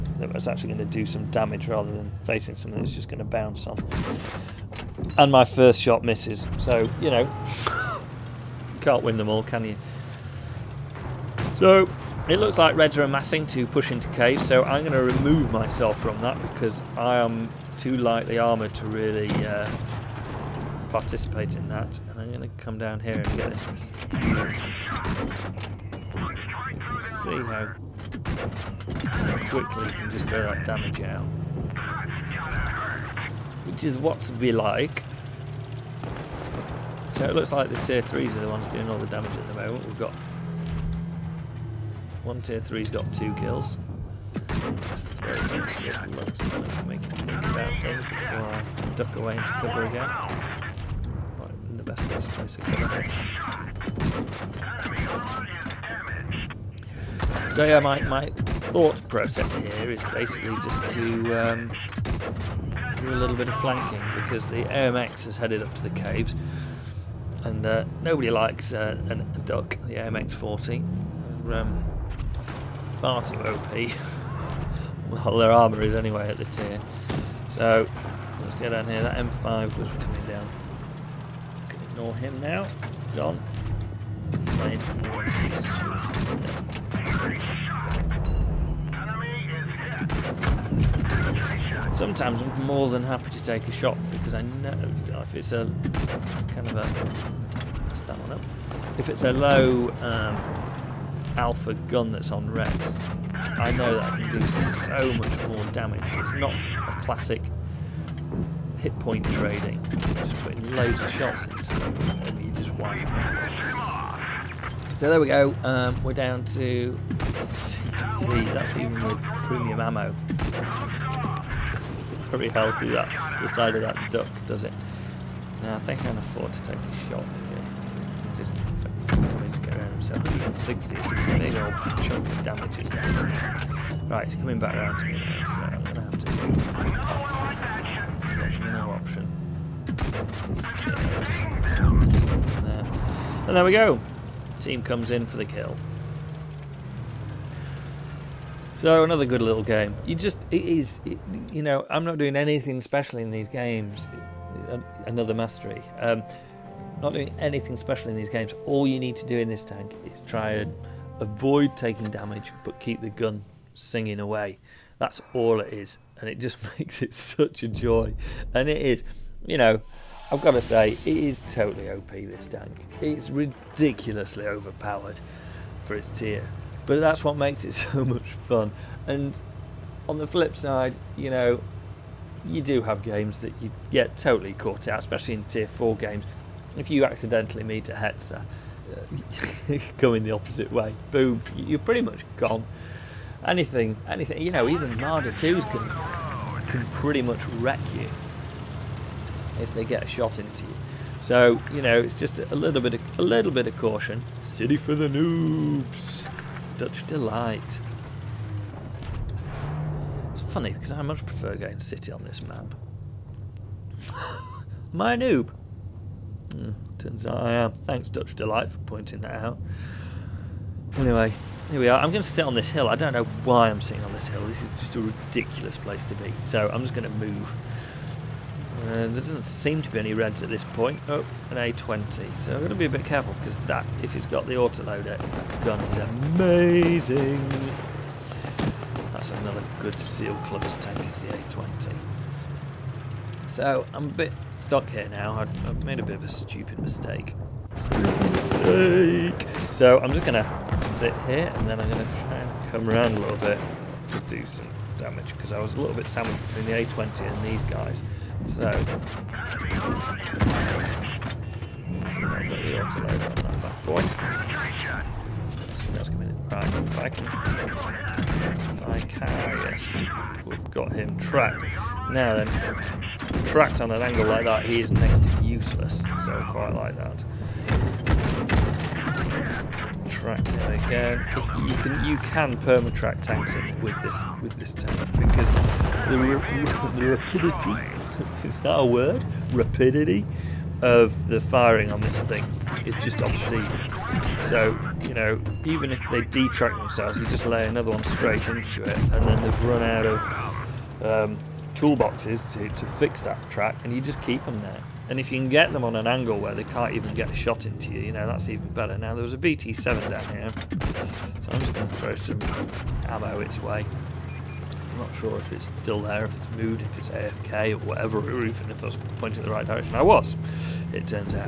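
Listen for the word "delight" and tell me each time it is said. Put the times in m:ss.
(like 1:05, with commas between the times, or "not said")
3:27, 3:38.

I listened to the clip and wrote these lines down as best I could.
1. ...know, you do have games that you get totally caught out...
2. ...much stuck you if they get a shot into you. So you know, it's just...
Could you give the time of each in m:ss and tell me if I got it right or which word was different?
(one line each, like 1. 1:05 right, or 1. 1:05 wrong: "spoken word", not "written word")
1. 3:01 right
2. 3:17 wrong: "wreck", not "stuck".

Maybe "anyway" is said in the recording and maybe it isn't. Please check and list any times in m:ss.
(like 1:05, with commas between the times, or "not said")
1:15, 3:40.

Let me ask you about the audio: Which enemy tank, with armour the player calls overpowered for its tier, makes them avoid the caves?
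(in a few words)
AMX 40.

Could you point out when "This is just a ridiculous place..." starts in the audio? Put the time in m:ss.
3:44.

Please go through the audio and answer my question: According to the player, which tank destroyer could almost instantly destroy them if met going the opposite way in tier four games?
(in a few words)
Hetzer.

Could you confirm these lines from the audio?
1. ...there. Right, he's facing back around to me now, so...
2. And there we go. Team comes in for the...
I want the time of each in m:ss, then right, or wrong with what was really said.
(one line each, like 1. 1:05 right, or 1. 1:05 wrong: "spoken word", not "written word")
1. 2:12 wrong: "coming", not "facing"
2. 2:23 right.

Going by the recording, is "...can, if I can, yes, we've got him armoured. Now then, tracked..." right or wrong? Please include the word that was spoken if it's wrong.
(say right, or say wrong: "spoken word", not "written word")
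wrong: "tracked", not "armoured".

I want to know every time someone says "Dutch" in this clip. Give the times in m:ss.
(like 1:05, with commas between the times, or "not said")
3:26, 3:38.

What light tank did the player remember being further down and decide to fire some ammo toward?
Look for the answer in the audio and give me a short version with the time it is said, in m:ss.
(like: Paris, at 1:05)
BT-7, at 5:09.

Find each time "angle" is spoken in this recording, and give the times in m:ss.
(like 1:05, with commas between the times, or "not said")
4:34, 5:06.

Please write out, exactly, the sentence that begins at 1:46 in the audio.
It's not a classic hit point trading.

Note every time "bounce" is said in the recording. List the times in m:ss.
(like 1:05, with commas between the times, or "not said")
0:03.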